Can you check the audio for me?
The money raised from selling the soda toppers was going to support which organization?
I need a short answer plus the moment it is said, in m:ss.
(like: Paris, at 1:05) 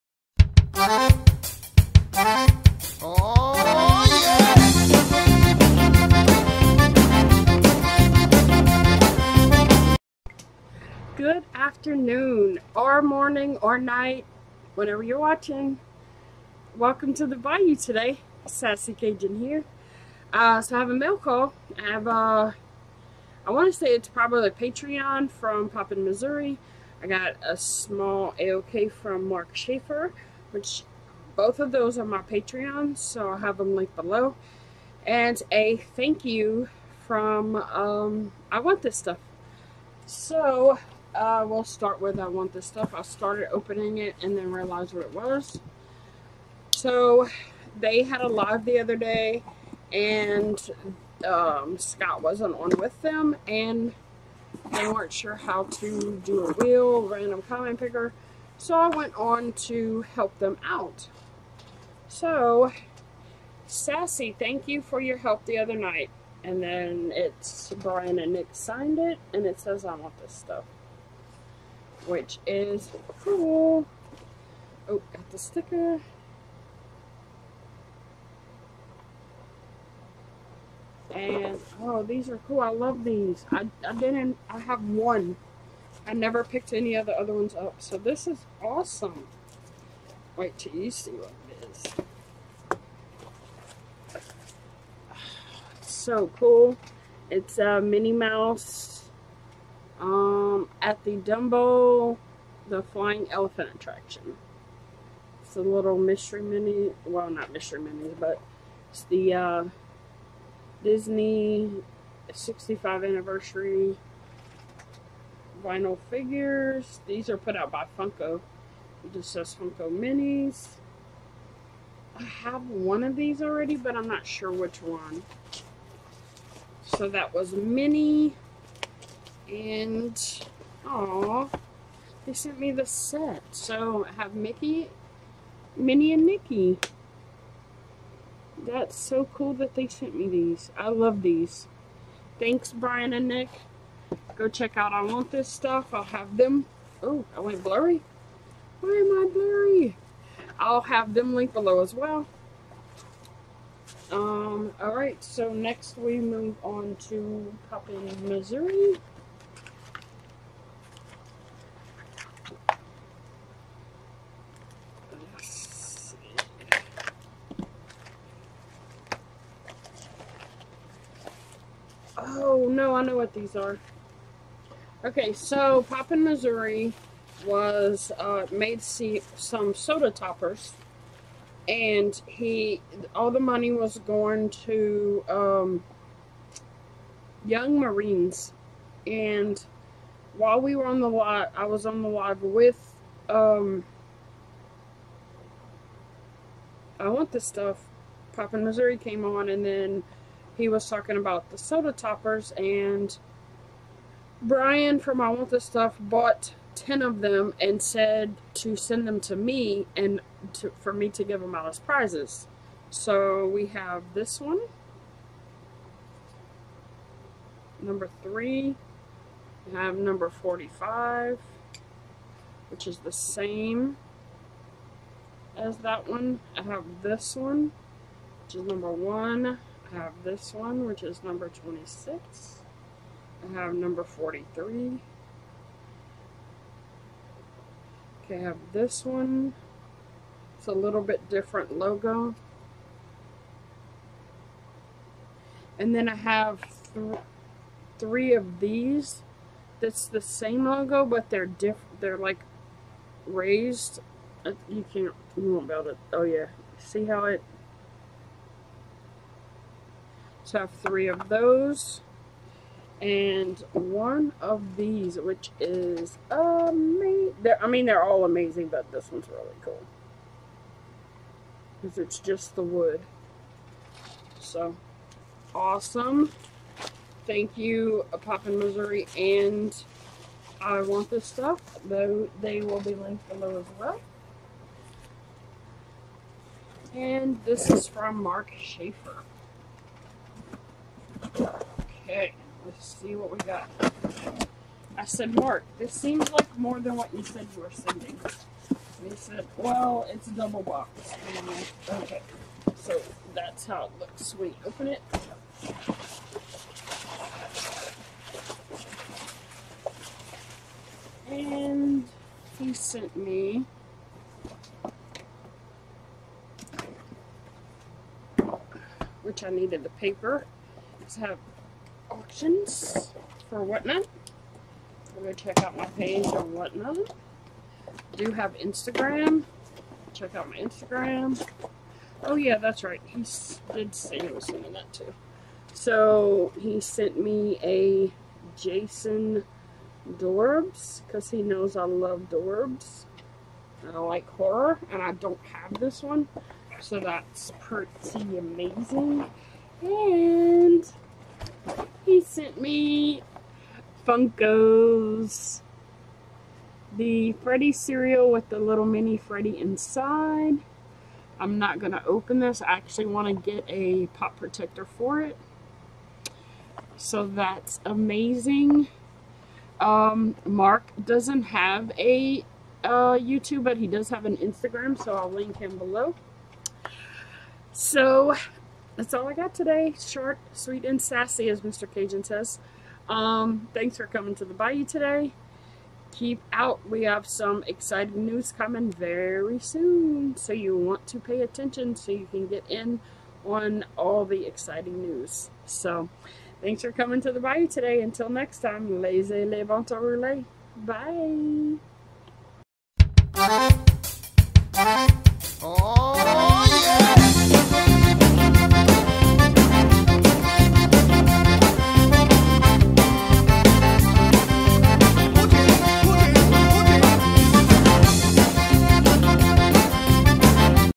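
young Marines, at 3:07.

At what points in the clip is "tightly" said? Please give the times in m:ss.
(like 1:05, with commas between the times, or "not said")
not said.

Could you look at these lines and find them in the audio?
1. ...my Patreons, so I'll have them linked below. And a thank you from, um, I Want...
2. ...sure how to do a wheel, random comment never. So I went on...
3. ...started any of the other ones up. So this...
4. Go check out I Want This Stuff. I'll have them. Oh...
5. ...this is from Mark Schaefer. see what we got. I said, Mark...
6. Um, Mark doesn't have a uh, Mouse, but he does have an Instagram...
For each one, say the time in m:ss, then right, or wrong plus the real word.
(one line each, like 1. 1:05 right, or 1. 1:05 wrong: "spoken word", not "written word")
1. 0:32 right
2. 0:55 wrong: "picker", not "never"
3. 1:26 wrong: "picked", not "started"
4. 2:24 right
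5. 4:47 right
6. 6:09 wrong: "YouTube", not "Mouse".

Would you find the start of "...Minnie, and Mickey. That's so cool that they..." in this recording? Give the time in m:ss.
2:15.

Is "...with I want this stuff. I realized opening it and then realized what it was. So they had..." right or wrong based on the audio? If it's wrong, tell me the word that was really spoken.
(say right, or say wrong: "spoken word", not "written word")
wrong: "started", not "realized".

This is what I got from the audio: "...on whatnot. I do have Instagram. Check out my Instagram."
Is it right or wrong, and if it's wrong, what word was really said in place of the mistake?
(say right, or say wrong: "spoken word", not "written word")
right.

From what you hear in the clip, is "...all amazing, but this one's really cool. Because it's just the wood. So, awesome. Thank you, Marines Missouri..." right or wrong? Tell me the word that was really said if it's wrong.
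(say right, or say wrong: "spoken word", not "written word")
wrong: "Poppin", not "Marines".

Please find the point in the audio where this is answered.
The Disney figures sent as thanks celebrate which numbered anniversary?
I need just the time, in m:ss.
1:52.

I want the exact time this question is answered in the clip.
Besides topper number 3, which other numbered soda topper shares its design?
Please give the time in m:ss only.
3:40.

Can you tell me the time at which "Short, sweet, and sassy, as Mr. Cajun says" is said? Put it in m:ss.
6:19.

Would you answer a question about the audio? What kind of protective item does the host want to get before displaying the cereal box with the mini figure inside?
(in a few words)
pop protector.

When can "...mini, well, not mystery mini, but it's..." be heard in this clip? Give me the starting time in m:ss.
1:46.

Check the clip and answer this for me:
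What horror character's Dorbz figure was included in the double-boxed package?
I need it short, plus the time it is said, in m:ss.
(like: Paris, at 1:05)
Jason, at 5:38.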